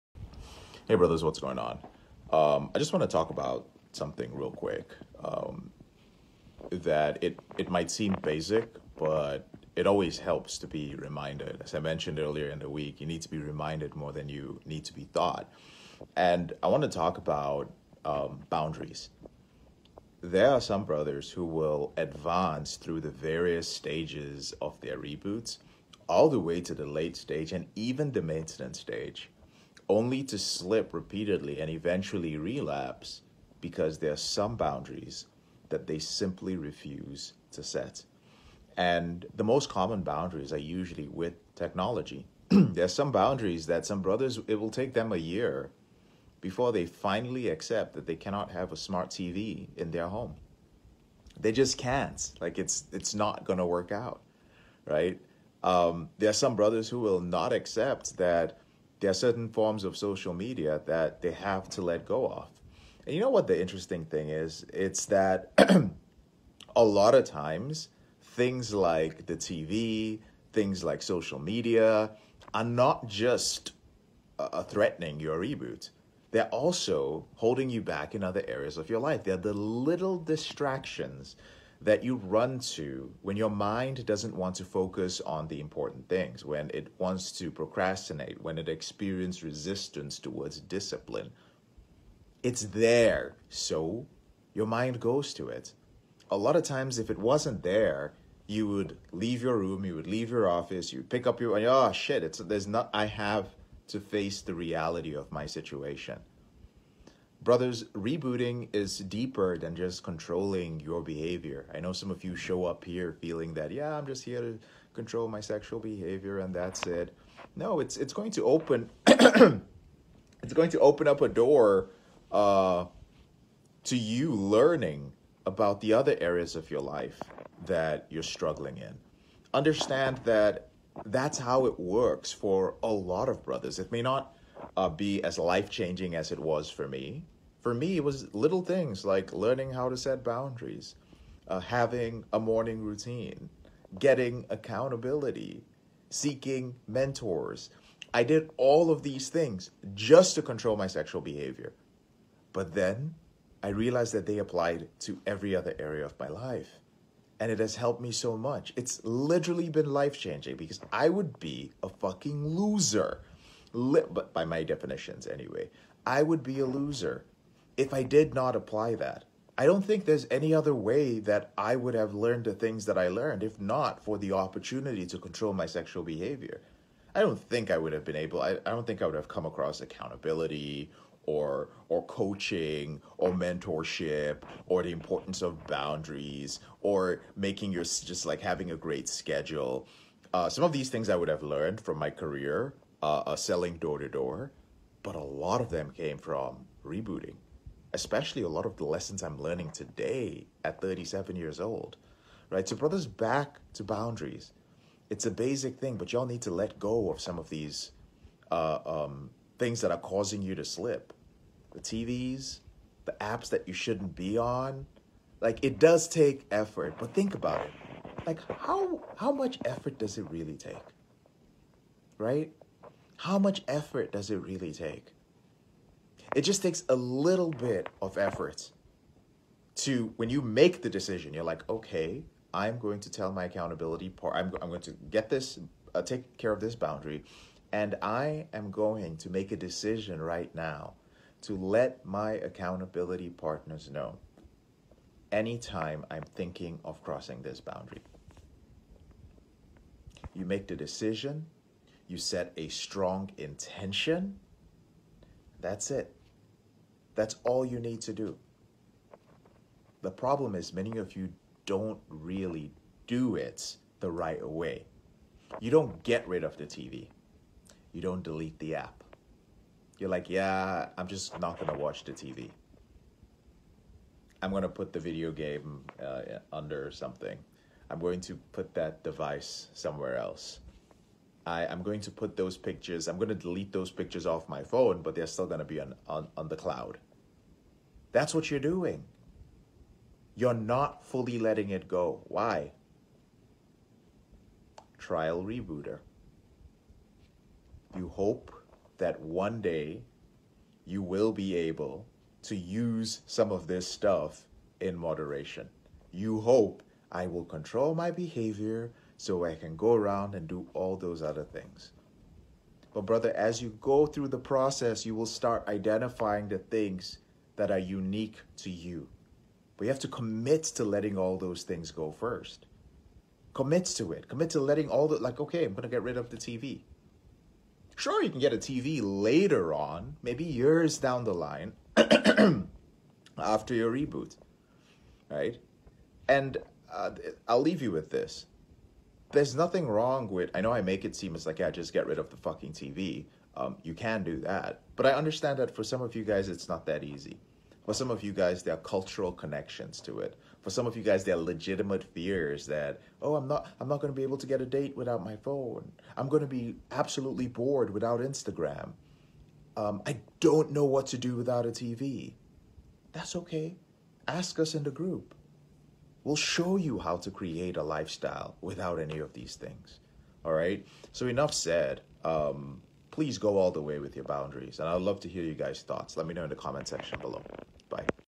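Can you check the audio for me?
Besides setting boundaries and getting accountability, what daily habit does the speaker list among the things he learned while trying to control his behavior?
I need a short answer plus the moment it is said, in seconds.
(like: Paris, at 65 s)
morning routine, at 142 s.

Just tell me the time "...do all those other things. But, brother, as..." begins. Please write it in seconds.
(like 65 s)
310 s.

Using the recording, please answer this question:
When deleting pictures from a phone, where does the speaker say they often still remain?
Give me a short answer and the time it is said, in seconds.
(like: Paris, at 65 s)
the cloud, at 286 s.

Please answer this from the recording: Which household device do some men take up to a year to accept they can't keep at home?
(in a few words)
smart TV.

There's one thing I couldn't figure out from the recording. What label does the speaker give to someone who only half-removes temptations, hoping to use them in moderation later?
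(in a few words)
Trial rebooter.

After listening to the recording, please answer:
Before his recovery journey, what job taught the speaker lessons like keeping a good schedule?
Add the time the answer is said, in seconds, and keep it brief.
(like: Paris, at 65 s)
selling door to door, at 193 s.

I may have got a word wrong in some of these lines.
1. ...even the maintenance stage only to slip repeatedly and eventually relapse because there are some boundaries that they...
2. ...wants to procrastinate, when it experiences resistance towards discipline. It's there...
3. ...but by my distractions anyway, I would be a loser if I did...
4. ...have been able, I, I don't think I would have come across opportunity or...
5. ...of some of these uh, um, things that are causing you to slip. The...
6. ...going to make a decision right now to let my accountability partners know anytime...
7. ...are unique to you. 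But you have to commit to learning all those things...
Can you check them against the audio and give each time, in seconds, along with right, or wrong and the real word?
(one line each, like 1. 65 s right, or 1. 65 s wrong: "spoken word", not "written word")
1. 27 s right
2. 86 s right
3. 163 s wrong: "definitions", not "distractions"
4. 177 s wrong: "accountability", not "opportunity"
5. 207 s right
6. 238 s right
7. 317 s wrong: "letting", not "learning".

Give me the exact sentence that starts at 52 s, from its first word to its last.
Like it's it's not gonna work out, right?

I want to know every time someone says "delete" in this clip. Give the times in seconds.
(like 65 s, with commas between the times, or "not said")
268 s, 283 s.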